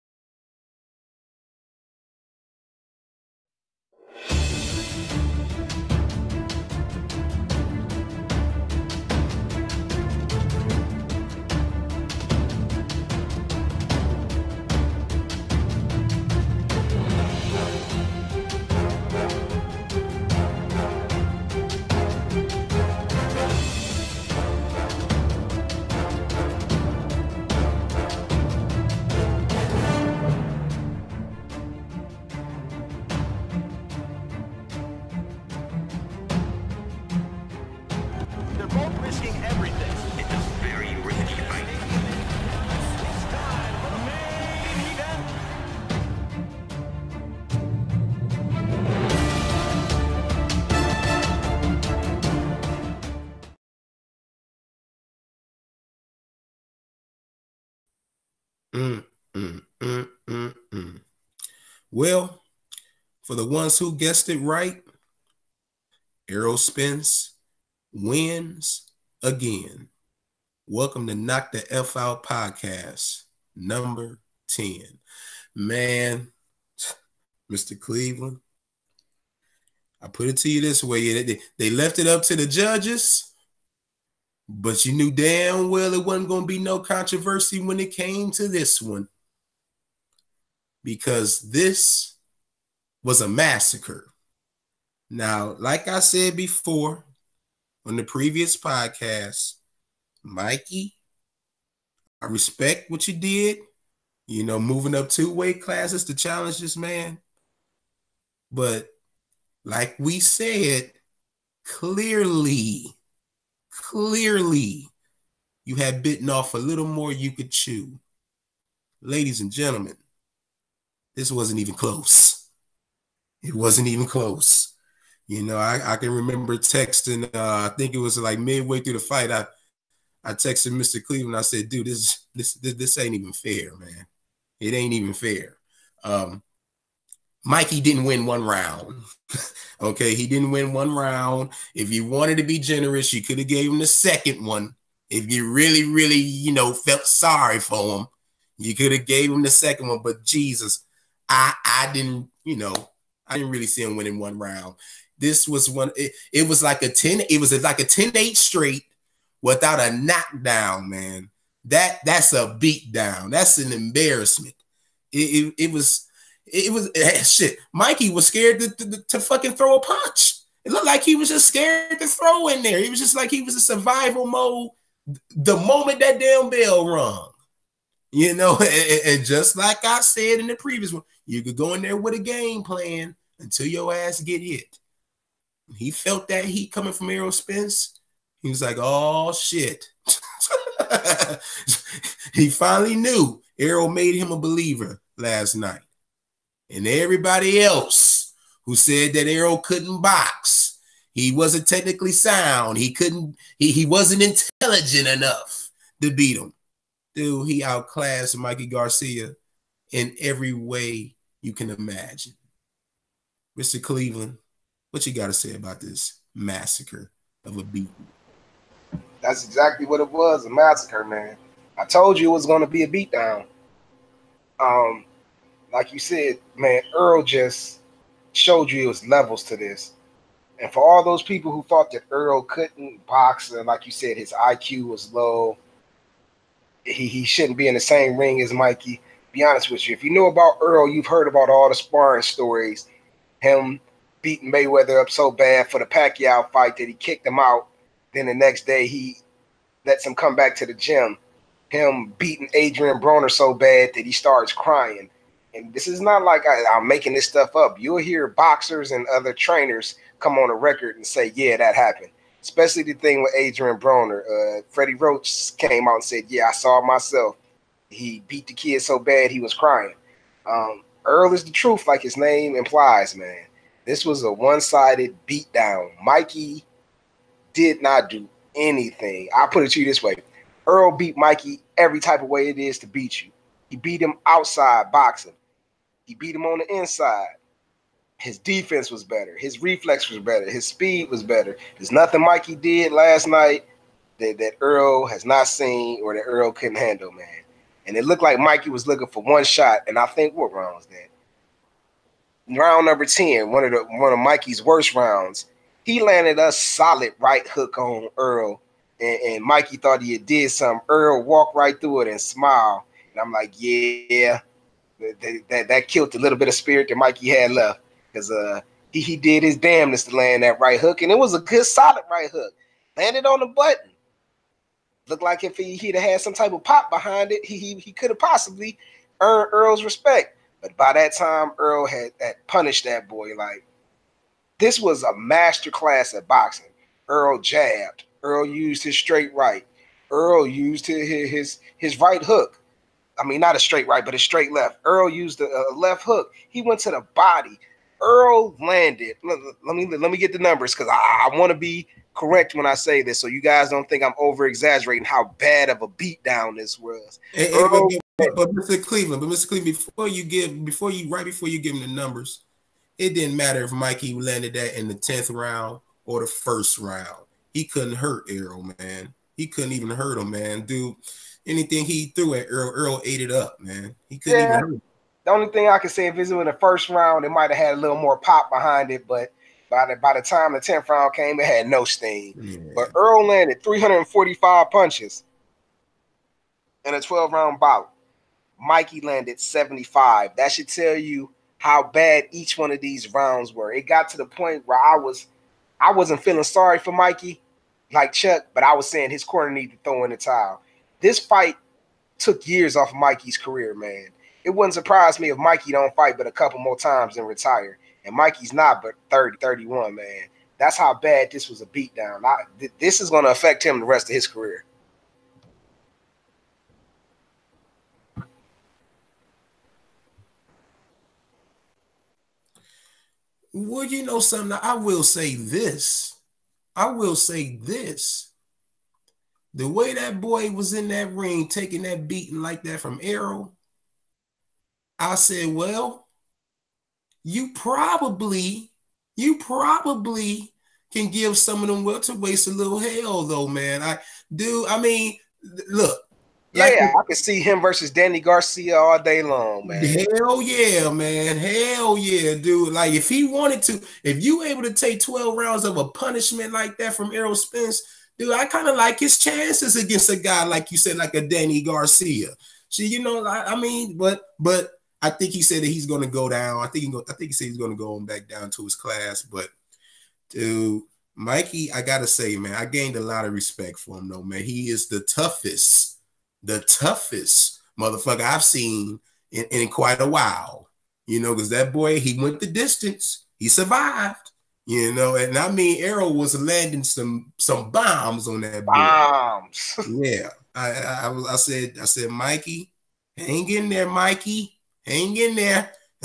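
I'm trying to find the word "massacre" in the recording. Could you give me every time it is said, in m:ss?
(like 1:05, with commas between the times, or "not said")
1:33, 3:36, 3:40.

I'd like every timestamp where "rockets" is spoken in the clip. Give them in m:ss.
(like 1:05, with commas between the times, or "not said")
not said.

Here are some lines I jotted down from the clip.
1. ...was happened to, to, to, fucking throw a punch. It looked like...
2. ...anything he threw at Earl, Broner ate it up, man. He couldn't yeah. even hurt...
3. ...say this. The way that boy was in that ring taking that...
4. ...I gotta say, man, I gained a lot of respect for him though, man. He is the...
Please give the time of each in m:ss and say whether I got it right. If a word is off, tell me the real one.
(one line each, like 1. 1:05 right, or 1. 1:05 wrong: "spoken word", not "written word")
1. 2:48 wrong: "scared", not "happened"
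2. 6:11 wrong: "Earl", not "Broner"
3. 7:07 right
4. 7:51 right.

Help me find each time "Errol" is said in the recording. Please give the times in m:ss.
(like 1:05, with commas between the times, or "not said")
1:06, 3:07, 3:13, 3:19, 7:13, 7:37, 8:05.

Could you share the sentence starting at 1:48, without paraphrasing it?
But like we said, clearly, clearly, you had bitten off a little more you could chew.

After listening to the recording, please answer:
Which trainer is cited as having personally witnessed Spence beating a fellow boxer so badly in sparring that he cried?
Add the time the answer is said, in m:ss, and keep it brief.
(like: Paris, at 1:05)
Freddie Roach, at 4:24.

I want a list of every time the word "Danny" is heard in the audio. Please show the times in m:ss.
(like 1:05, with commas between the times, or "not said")
7:27, 7:41.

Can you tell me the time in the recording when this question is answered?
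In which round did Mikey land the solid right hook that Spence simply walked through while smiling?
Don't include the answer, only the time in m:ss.
5:02.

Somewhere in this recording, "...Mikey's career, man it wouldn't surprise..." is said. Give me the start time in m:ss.
6:42.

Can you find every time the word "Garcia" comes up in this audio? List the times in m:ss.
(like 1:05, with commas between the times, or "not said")
3:28, 7:28, 7:41.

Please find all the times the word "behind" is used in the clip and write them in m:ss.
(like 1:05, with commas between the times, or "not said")
5:26, 6:18.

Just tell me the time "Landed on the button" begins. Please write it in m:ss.
5:22.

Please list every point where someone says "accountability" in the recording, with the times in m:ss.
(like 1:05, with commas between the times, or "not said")
not said.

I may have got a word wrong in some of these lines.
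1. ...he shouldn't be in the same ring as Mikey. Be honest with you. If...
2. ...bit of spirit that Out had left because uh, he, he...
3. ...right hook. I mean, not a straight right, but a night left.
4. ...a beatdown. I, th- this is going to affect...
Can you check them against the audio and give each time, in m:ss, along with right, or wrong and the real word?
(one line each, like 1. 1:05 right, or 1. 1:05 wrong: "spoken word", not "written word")
1. 3:57 right
2. 5:16 wrong: "Mikey", not "Out"
3. 5:41 wrong: "straight", not "night"
4. 6:51 right.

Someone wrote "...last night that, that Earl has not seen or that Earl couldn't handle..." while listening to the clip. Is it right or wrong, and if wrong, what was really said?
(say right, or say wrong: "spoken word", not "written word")
right.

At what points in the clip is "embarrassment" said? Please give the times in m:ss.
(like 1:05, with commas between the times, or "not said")
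2:43.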